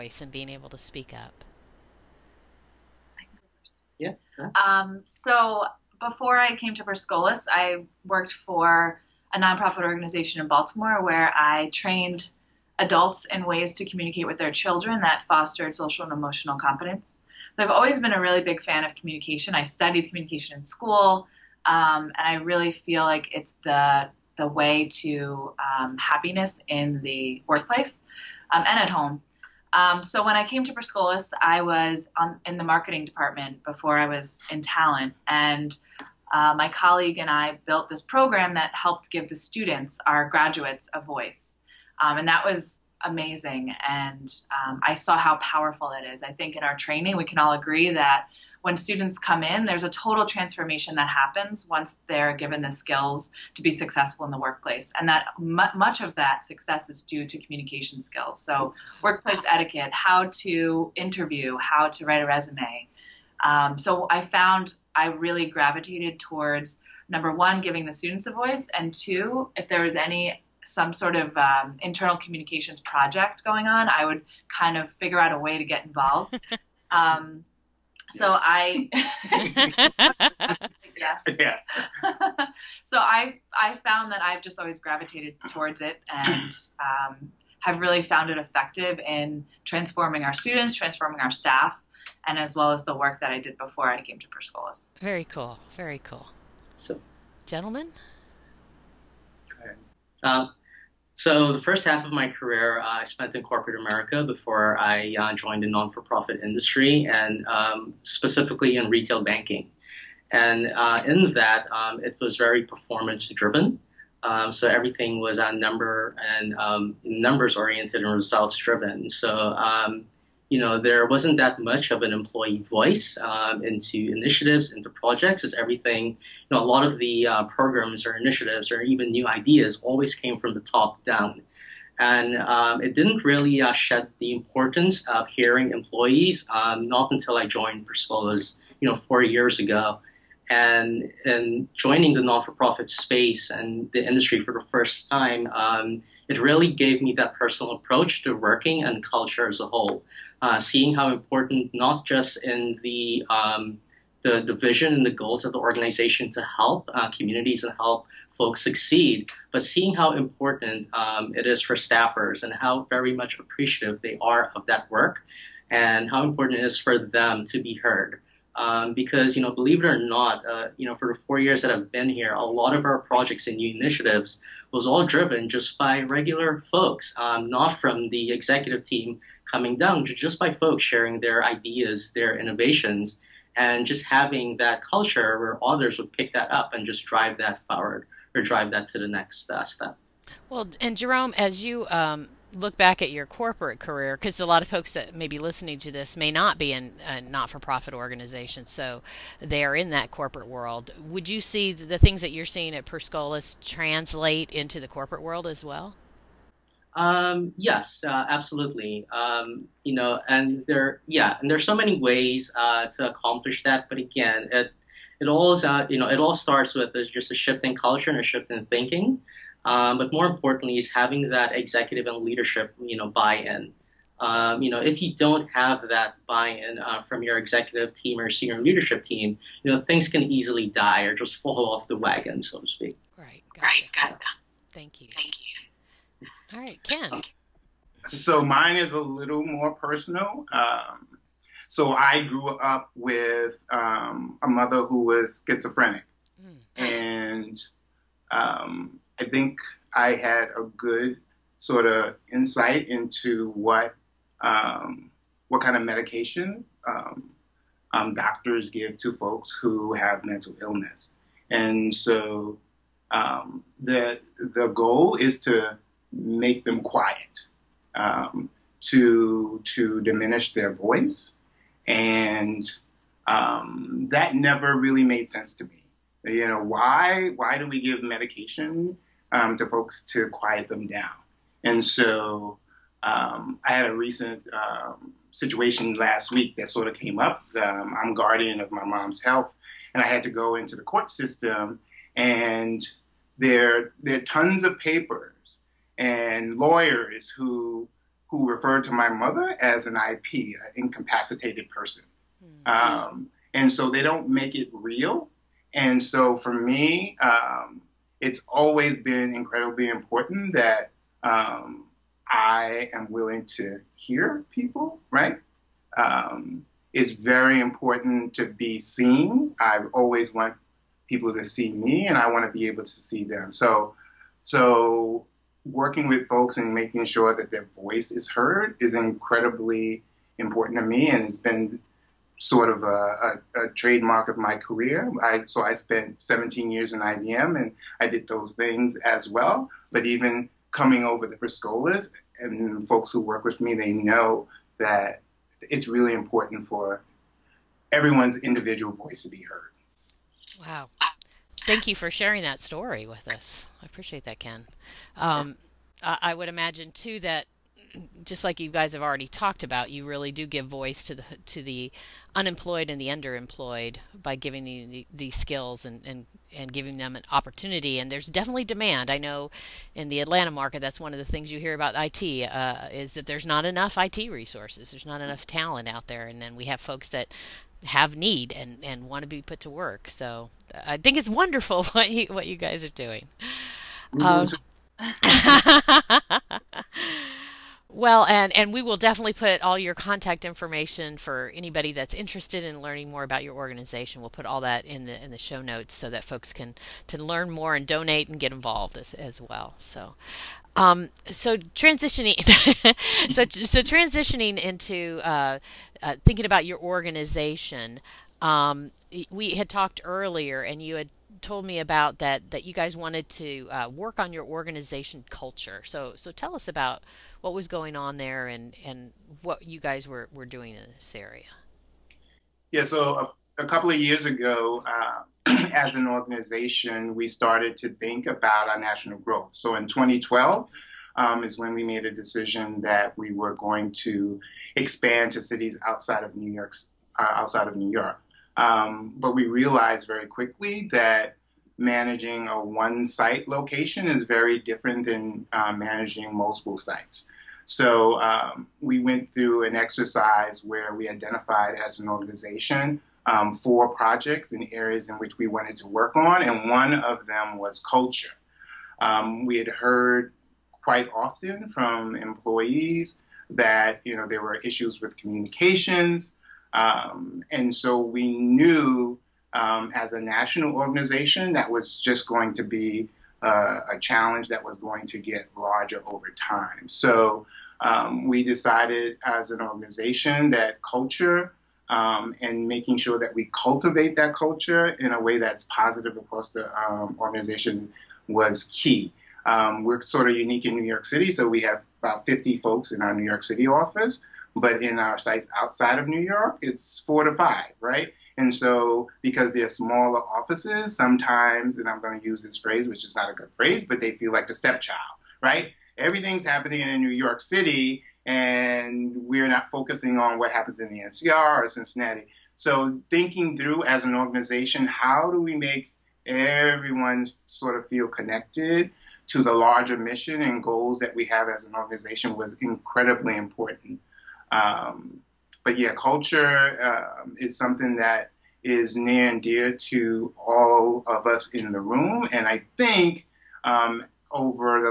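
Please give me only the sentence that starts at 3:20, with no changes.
Would you see the things that you're seeing at Per Scholas translate into the corporate world as well?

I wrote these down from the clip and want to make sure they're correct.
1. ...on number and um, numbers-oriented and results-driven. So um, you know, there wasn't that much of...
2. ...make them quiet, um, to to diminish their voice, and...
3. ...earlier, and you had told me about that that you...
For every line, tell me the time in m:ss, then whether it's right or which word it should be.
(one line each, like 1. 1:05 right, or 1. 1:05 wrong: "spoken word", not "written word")
1. 1:55 right
2. 4:26 right
3. 6:50 right.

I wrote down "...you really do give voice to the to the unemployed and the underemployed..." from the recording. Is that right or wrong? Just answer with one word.
right.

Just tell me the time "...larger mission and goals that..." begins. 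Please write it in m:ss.
8:39.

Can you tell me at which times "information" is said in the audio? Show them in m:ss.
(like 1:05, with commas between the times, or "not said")
6:30.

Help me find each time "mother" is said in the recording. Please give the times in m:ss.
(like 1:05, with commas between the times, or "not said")
4:04, 4:59.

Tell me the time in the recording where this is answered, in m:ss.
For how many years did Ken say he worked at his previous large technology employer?
5:36.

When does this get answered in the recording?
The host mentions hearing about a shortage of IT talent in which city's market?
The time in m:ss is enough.
6:10.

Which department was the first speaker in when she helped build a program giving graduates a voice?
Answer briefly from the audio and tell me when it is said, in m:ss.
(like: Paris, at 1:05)
Marketing, at 0:32.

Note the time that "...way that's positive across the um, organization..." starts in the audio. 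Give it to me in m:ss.
8:05.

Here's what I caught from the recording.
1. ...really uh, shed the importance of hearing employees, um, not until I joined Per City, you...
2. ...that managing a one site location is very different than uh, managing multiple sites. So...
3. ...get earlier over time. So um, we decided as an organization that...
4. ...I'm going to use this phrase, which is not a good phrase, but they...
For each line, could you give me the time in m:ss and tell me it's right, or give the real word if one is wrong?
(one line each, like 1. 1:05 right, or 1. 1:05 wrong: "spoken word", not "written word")
1. 2:13 wrong: "Scholas", not "City"
2. 7:20 right
3. 7:55 wrong: "larger", not "earlier"
4. 8:21 right.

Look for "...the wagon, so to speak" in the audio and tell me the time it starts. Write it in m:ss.
3:51.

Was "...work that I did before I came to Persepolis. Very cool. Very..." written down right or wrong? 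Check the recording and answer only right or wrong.
right.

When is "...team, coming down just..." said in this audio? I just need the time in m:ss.
2:58.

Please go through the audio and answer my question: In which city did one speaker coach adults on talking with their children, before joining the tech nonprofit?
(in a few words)
Baltimore.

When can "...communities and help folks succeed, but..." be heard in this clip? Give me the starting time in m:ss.
2:37.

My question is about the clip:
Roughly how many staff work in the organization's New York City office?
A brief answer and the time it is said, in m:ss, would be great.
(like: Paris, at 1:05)
About 50, at 8:12.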